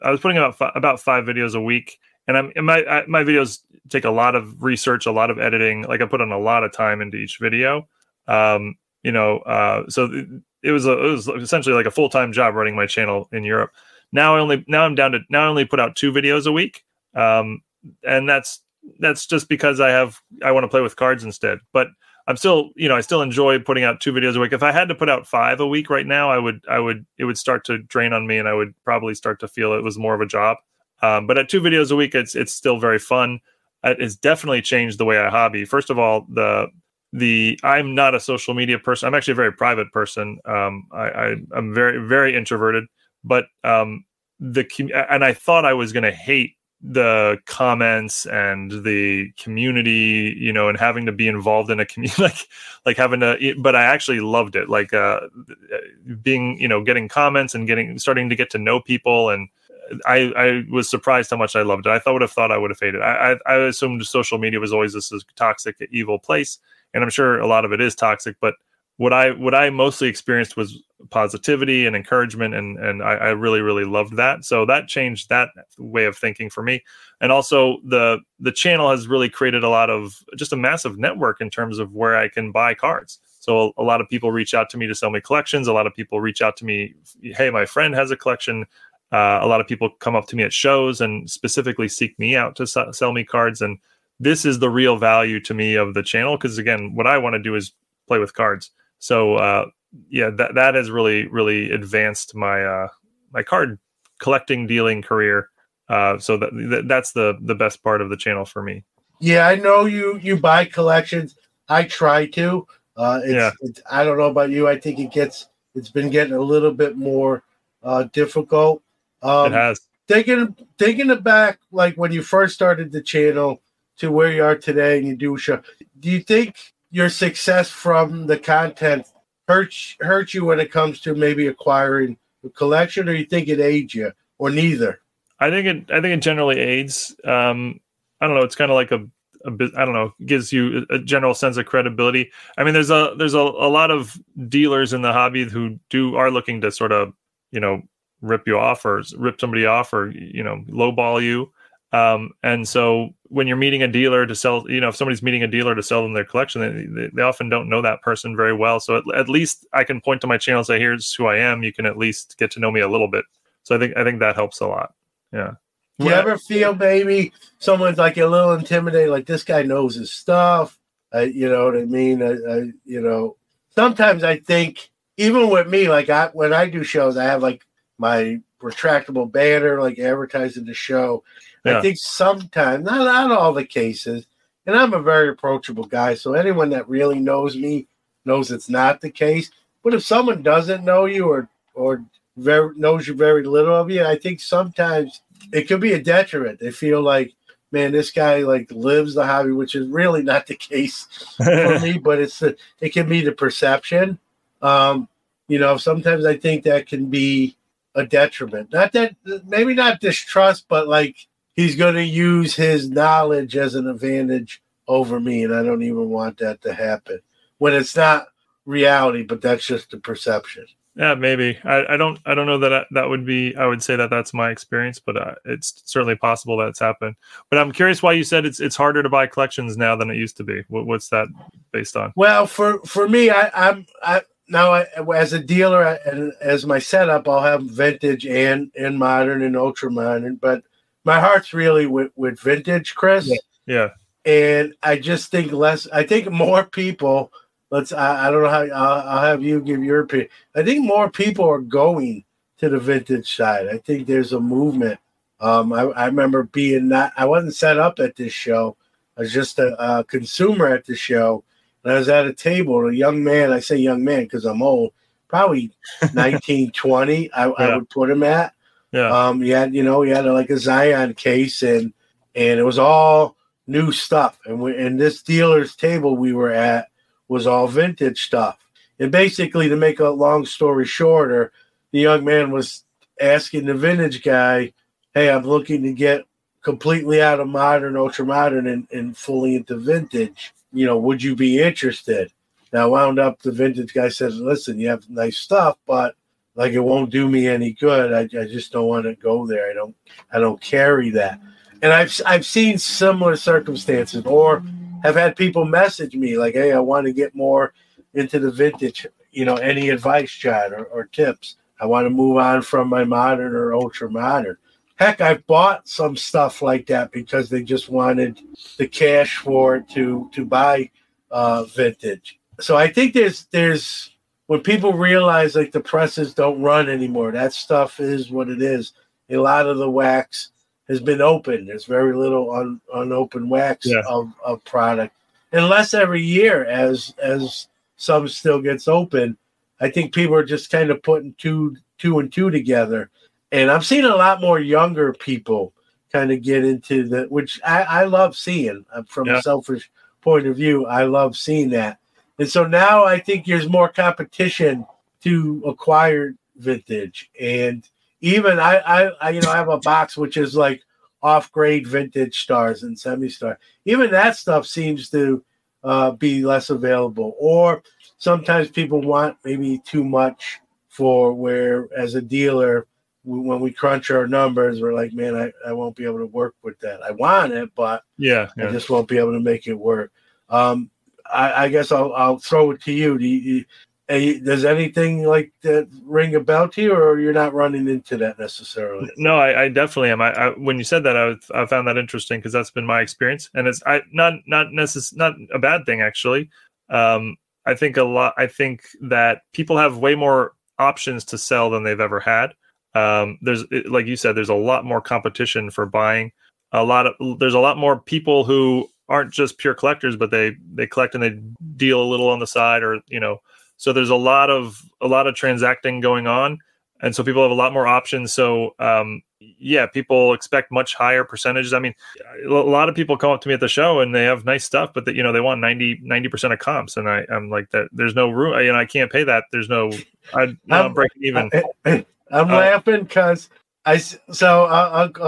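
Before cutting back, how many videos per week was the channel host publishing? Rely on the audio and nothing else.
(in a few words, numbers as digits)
5.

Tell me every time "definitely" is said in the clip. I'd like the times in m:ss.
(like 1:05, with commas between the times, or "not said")
0:34, 6:29.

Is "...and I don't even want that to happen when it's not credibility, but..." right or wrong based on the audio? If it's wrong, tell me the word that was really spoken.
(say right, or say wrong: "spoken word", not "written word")
wrong: "reality", not "credibility".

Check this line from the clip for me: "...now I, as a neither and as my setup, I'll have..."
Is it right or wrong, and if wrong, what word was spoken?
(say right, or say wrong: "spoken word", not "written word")
wrong: "dealer", not "neither".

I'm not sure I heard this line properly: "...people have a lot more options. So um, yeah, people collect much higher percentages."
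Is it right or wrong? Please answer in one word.
wrong.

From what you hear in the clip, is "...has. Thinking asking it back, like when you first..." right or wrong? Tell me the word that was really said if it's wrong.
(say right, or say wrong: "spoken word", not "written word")
wrong: "thinking", not "asking".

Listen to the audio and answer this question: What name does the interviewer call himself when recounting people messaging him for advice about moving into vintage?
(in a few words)
Chad.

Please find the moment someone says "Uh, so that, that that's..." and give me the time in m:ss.
1:45.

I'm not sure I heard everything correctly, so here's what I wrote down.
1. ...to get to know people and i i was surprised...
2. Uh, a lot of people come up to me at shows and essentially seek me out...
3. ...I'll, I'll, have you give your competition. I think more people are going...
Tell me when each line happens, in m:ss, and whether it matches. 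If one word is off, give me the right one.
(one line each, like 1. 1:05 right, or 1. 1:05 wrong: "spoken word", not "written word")
1. 0:58 right
2. 1:29 wrong: "specifically", not "essentially"
3. 4:08 wrong: "opinion", not "competition".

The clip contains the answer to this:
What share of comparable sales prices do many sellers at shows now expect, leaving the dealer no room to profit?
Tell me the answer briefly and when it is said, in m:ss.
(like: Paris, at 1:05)
90 percent, at 7:05.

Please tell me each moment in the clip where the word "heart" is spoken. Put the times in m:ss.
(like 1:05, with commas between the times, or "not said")
4:01.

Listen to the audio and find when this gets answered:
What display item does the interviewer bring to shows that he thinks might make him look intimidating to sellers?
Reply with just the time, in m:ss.
2:58.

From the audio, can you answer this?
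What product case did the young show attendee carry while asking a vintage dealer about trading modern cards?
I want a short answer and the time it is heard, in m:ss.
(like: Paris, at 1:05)
Zion case, at 4:30.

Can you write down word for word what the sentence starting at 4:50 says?
You know, would you be interested?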